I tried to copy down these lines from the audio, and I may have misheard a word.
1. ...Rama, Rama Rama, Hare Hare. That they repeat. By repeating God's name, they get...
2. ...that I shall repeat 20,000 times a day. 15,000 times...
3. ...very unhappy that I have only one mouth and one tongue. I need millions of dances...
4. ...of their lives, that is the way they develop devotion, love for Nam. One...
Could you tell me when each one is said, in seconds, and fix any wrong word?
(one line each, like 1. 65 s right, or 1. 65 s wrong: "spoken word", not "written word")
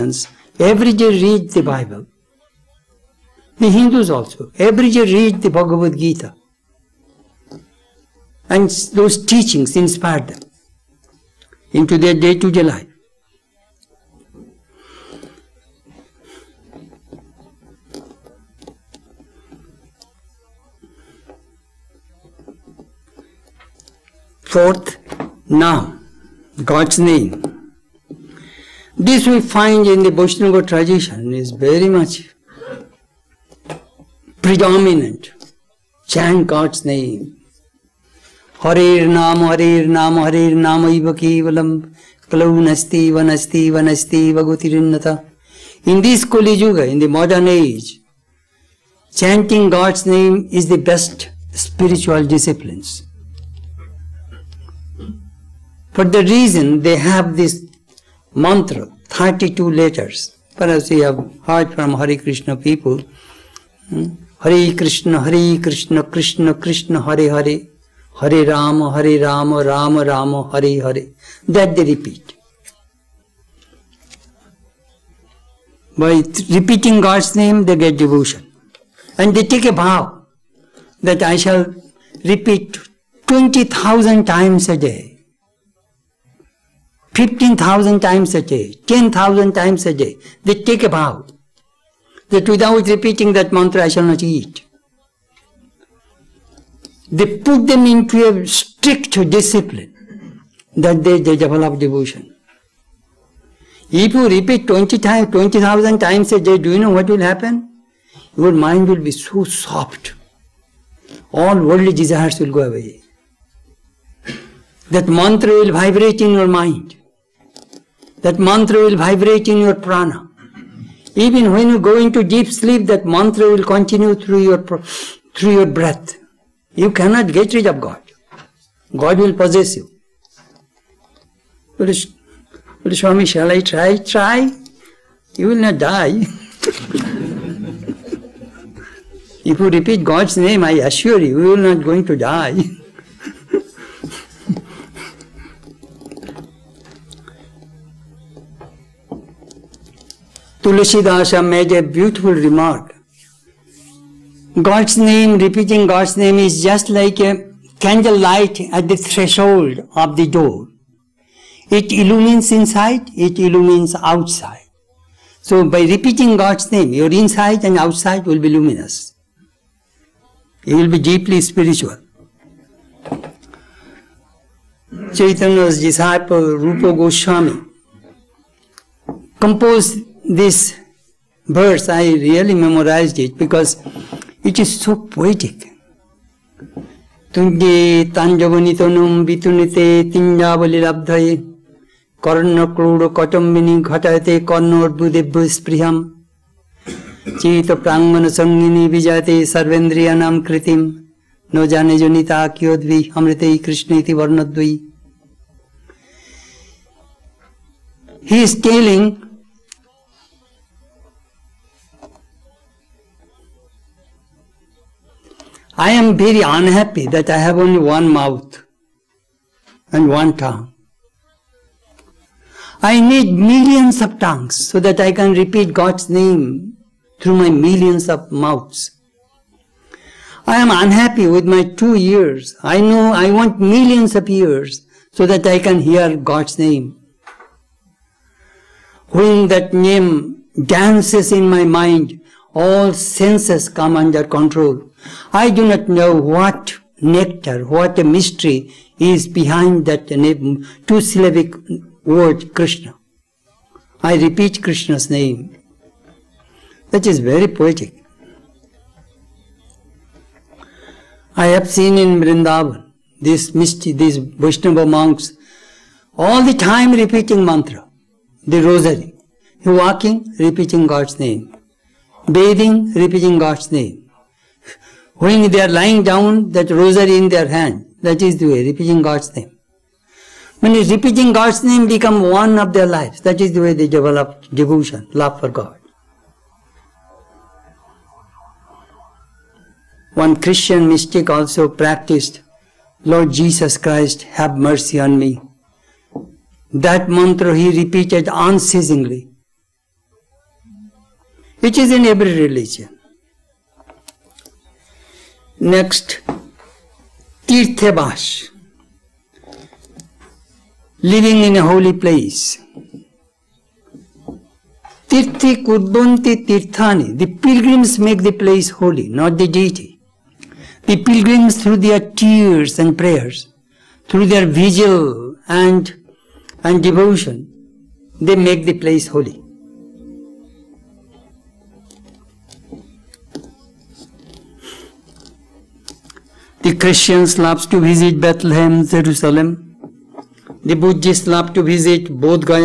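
1. 69 s right
2. 81 s right
3. 216 s wrong: "tongues", not "dances"
4. 282 s wrong: "God", not "Nam".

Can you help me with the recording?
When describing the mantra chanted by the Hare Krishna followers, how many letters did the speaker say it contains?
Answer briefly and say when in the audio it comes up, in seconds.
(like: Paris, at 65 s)
32, at 59 s.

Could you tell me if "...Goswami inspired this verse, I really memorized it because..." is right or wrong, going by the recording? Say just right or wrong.
wrong.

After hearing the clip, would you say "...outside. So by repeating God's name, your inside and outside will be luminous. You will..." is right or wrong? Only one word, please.
right.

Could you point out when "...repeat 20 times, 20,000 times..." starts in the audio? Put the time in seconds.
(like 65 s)
104 s.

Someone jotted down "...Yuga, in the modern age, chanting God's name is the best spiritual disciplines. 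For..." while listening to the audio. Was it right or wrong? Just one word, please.
right.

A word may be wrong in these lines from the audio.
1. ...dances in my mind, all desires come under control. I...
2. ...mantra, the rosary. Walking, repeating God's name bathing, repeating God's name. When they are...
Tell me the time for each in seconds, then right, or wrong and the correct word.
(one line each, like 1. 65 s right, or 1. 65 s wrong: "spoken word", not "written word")
1. 240 s wrong: "senses", not "desires"
2. 267 s right.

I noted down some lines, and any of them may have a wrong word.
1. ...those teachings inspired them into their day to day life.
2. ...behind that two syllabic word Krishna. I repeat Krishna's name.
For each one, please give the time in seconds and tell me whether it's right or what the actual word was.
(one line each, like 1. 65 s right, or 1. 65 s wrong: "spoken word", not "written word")
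1. 8 s right
2. 249 s right.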